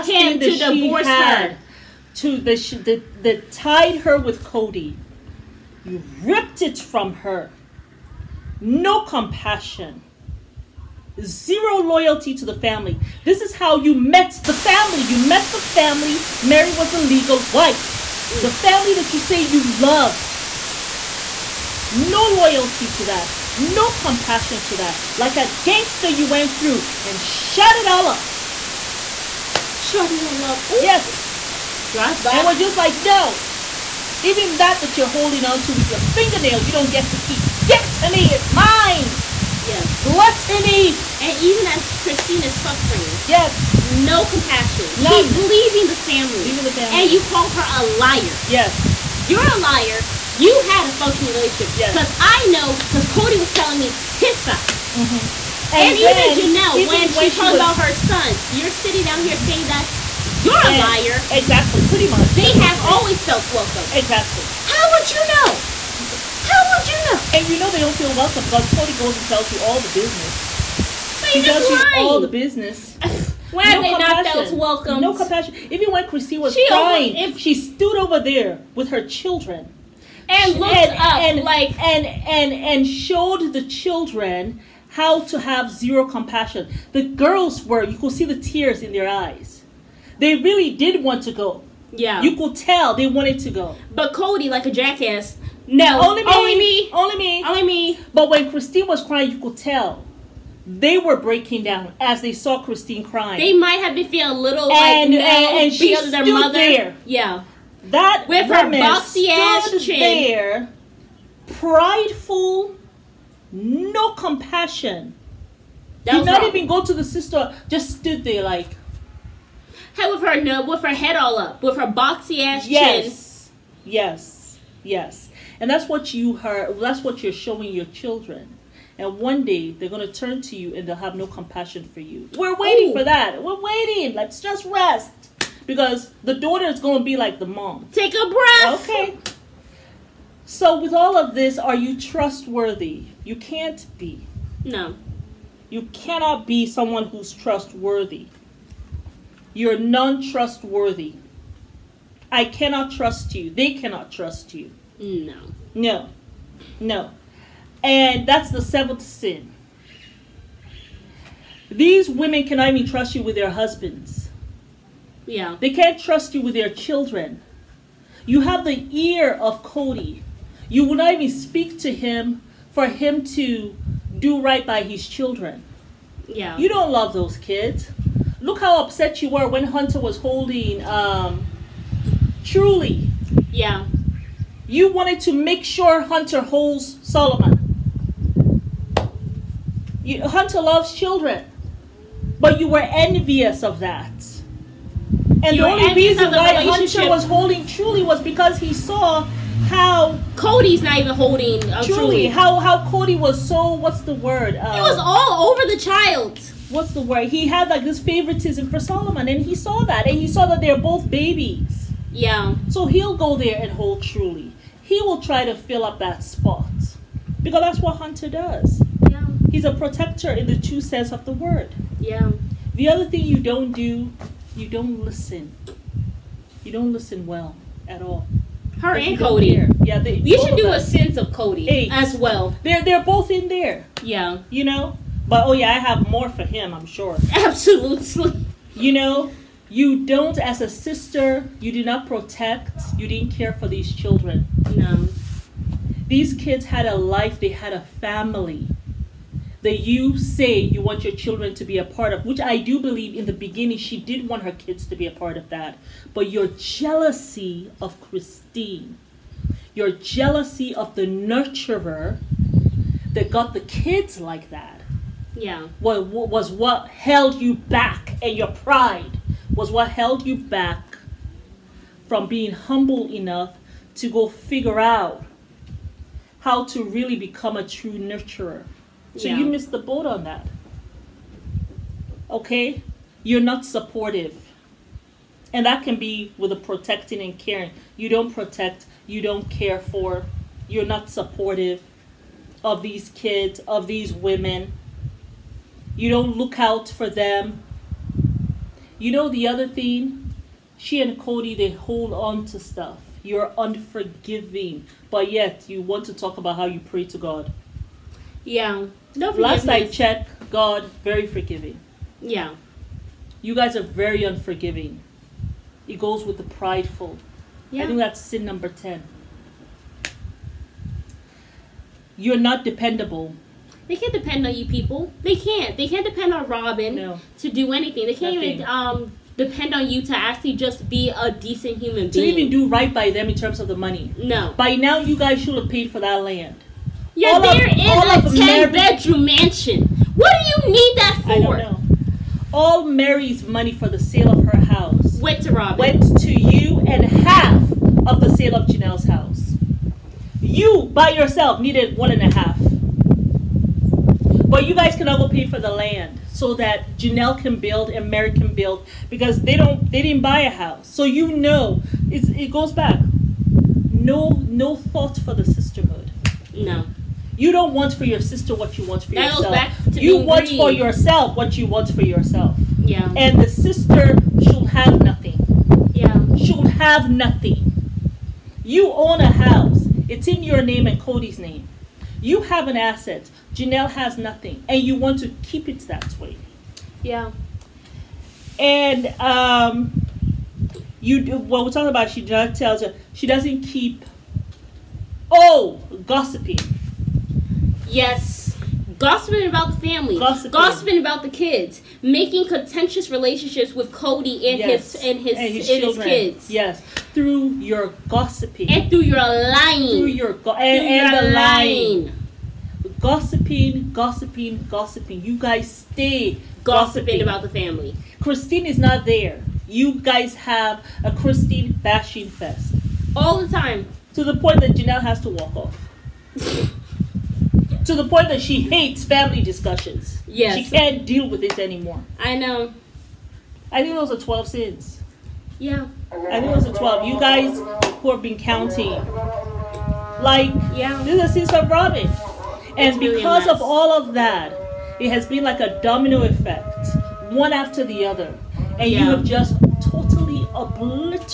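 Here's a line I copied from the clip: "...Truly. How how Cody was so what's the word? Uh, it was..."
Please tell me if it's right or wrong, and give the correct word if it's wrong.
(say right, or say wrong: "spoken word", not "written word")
right.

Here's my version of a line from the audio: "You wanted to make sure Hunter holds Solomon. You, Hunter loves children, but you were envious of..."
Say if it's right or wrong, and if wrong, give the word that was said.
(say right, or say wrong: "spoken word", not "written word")
right.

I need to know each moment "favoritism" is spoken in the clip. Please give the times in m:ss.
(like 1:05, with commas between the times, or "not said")
3:28.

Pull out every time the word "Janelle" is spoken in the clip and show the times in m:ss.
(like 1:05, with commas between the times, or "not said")
0:56, 5:48, 5:56, 6:23, 7:04.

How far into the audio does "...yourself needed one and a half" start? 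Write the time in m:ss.
5:51.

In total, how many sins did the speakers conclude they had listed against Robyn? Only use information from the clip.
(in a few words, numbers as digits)
12.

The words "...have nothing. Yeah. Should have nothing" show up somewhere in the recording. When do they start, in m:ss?
6:14.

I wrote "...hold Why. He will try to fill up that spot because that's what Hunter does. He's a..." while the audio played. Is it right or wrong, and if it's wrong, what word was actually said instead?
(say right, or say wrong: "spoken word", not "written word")
wrong: "Truly", not "Why".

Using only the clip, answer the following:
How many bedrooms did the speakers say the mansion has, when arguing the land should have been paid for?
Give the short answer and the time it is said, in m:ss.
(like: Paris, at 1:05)
10, at 5:38.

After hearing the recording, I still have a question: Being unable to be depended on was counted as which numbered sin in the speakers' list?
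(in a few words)
10.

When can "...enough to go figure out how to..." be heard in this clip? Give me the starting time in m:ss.
4:33.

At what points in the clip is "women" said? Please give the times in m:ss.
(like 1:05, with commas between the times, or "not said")
2:42, 4:54.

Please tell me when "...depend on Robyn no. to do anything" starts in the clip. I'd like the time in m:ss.
5:26.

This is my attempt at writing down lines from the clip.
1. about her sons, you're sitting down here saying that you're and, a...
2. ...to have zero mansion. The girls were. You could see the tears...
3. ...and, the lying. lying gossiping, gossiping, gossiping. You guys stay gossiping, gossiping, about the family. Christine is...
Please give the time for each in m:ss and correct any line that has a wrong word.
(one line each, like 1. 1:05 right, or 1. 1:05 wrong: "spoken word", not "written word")
1. 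0:57 right
2. 1:25 wrong: "compassion", not "mansion"
3. 6:51 right.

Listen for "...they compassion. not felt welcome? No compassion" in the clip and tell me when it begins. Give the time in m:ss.
1:13.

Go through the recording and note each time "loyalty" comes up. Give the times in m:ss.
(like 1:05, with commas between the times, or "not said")
0:11, 0:22.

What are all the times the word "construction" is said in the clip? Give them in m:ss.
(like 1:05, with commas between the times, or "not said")
not said.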